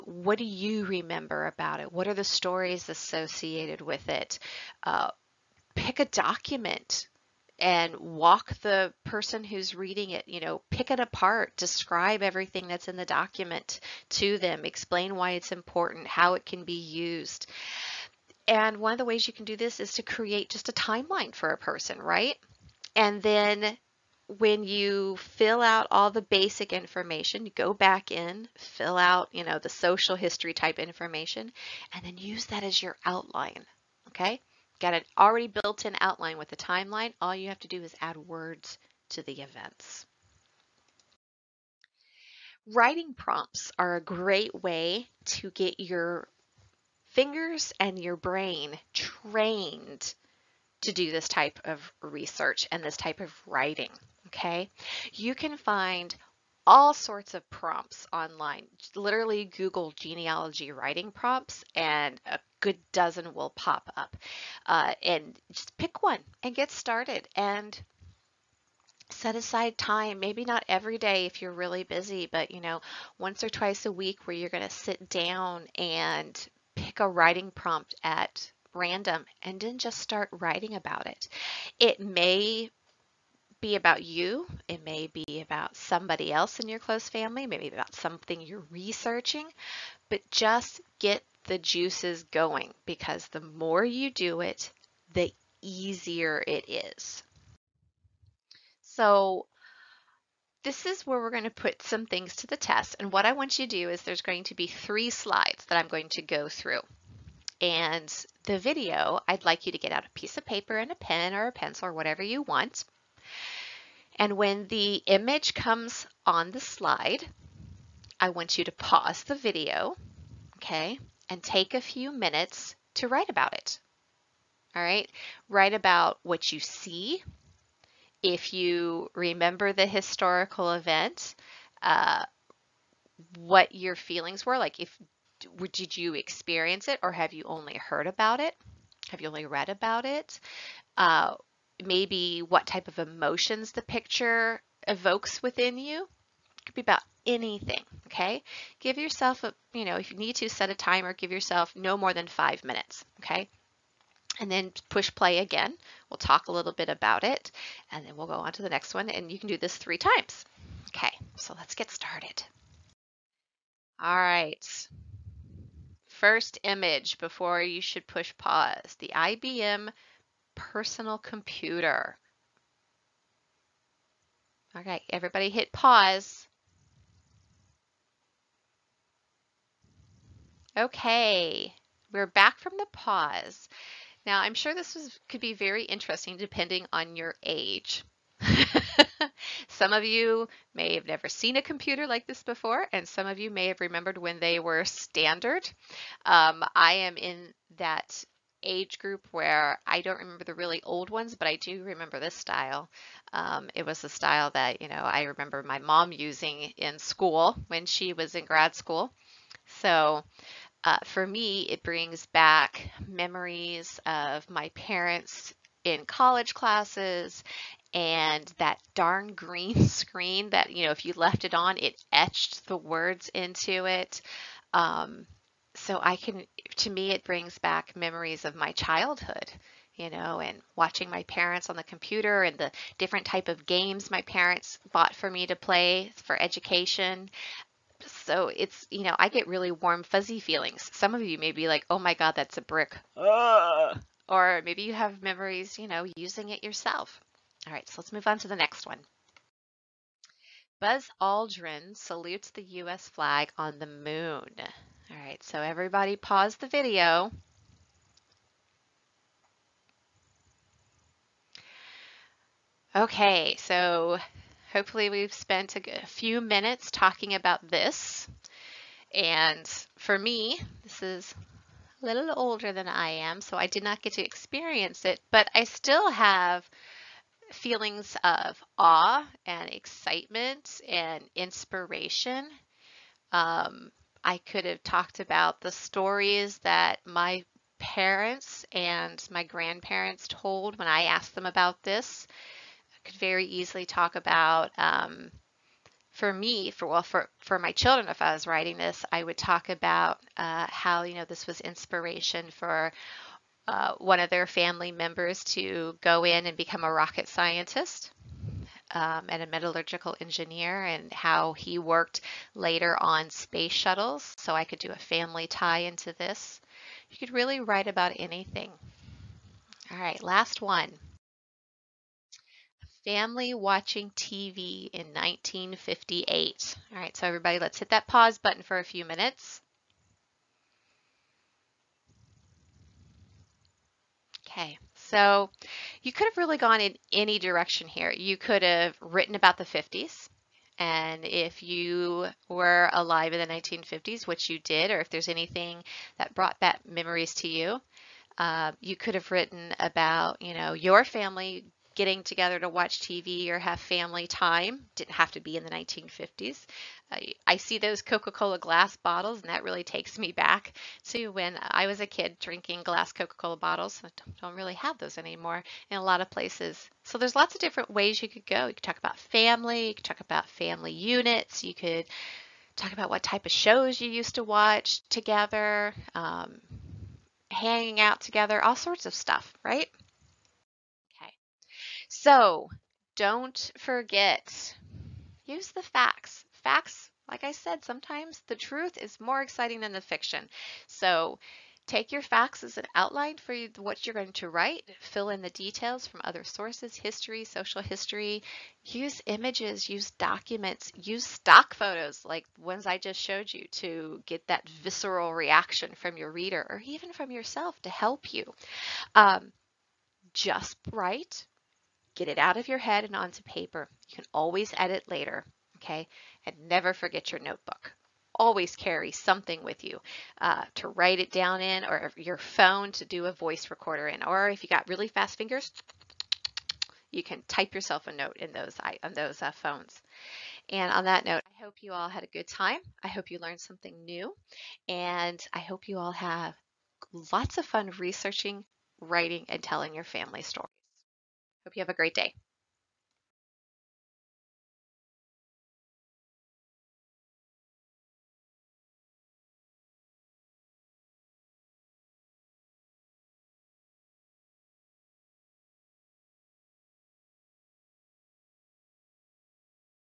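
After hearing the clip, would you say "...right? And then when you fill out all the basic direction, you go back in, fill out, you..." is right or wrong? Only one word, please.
wrong.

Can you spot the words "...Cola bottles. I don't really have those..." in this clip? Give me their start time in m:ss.
6:03.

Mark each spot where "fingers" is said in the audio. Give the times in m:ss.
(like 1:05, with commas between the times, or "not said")
0:47, 7:05.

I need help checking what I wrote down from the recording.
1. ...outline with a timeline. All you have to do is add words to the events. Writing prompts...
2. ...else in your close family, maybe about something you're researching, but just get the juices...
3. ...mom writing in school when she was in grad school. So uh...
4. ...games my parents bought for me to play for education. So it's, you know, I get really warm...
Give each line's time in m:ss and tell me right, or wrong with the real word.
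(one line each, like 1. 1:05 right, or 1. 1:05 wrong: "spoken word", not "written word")
1. 0:36 right
2. 1:26 right
3. 3:25 wrong: "using", not "writing"
4. 3:53 right.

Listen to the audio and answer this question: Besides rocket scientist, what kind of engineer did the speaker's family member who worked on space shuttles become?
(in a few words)
metallurgical engineer.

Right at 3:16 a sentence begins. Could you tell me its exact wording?
Um, I am in that age group where I don't remember the really old ones, but I do remember this style.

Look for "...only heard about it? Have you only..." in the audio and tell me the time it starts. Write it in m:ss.
2:17.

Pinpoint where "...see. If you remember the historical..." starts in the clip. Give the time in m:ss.
2:06.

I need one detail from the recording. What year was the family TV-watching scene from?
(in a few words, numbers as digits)
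1958.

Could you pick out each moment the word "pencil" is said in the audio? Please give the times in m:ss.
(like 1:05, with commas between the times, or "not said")
1:51.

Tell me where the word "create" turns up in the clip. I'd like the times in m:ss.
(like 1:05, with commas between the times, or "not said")
0:20.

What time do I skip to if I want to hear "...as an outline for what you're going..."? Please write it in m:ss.
6:32.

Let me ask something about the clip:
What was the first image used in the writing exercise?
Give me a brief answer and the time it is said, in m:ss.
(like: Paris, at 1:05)
IBM personal computer, at 2:48.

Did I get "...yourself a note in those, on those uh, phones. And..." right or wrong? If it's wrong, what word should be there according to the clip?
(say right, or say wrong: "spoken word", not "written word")
right.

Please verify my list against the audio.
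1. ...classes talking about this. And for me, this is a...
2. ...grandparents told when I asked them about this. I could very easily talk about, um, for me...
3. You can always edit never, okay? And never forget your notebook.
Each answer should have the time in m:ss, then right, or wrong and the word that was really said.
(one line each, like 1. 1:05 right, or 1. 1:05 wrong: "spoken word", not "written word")
1. 4:26 wrong: "minutes", not "classes"
2. 4:49 right
3. 6:54 wrong: "later", not "never".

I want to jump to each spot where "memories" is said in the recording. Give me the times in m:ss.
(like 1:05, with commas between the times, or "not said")
3:33, 3:47, 4:05, 5:46.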